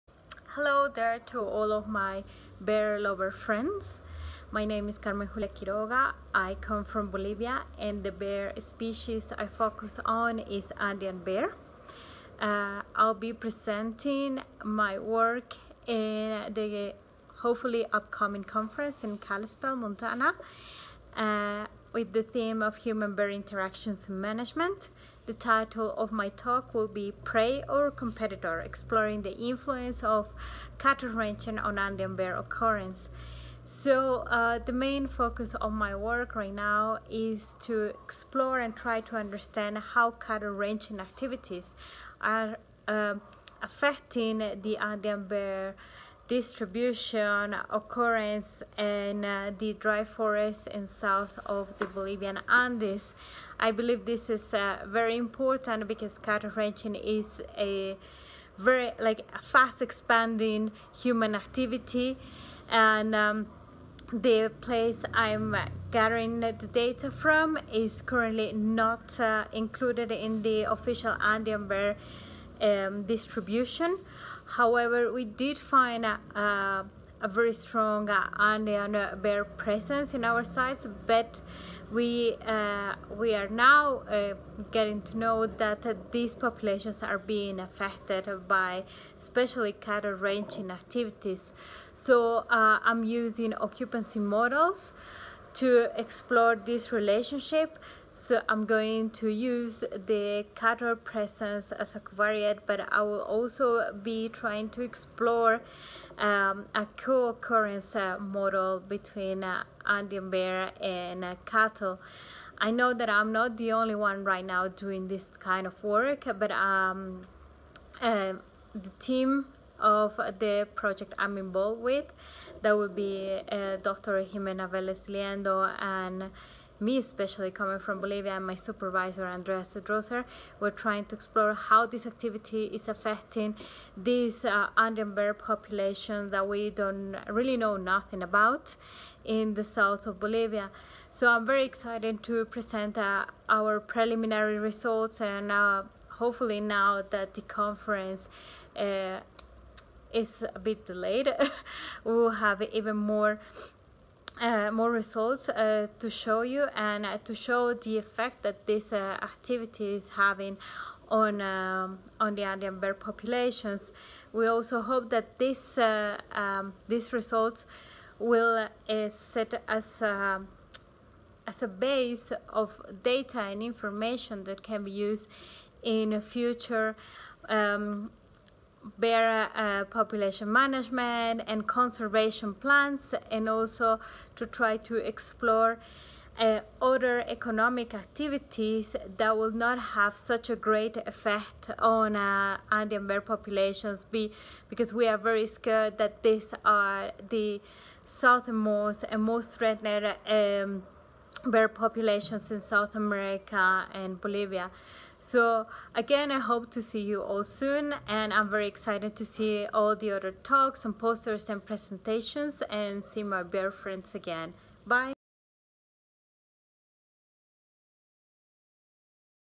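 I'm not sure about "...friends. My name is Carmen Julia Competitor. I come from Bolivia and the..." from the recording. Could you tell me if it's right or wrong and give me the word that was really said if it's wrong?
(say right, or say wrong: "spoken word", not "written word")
wrong: "Quiroga", not "Competitor".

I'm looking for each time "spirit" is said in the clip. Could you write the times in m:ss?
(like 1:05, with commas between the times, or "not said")
not said.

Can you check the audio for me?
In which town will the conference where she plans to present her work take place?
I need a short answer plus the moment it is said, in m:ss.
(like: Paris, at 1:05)
Kalispell, Montana, at 0:19.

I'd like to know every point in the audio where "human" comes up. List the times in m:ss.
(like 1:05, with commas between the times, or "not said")
0:22, 1:01.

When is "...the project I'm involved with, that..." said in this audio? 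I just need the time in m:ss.
2:00.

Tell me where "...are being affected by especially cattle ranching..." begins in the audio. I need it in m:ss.
1:27.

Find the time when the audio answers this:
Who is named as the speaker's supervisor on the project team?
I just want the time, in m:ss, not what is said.
2:09.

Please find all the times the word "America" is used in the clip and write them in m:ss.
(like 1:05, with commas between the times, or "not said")
3:22.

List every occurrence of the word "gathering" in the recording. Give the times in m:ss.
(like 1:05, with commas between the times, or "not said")
1:05.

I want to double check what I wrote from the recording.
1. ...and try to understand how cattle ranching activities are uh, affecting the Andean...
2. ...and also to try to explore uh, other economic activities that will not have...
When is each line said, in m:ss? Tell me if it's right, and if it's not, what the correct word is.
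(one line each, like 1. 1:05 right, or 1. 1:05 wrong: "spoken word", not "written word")
1. 0:38 right
2. 3:03 right.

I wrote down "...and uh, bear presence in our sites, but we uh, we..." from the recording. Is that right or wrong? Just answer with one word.
right.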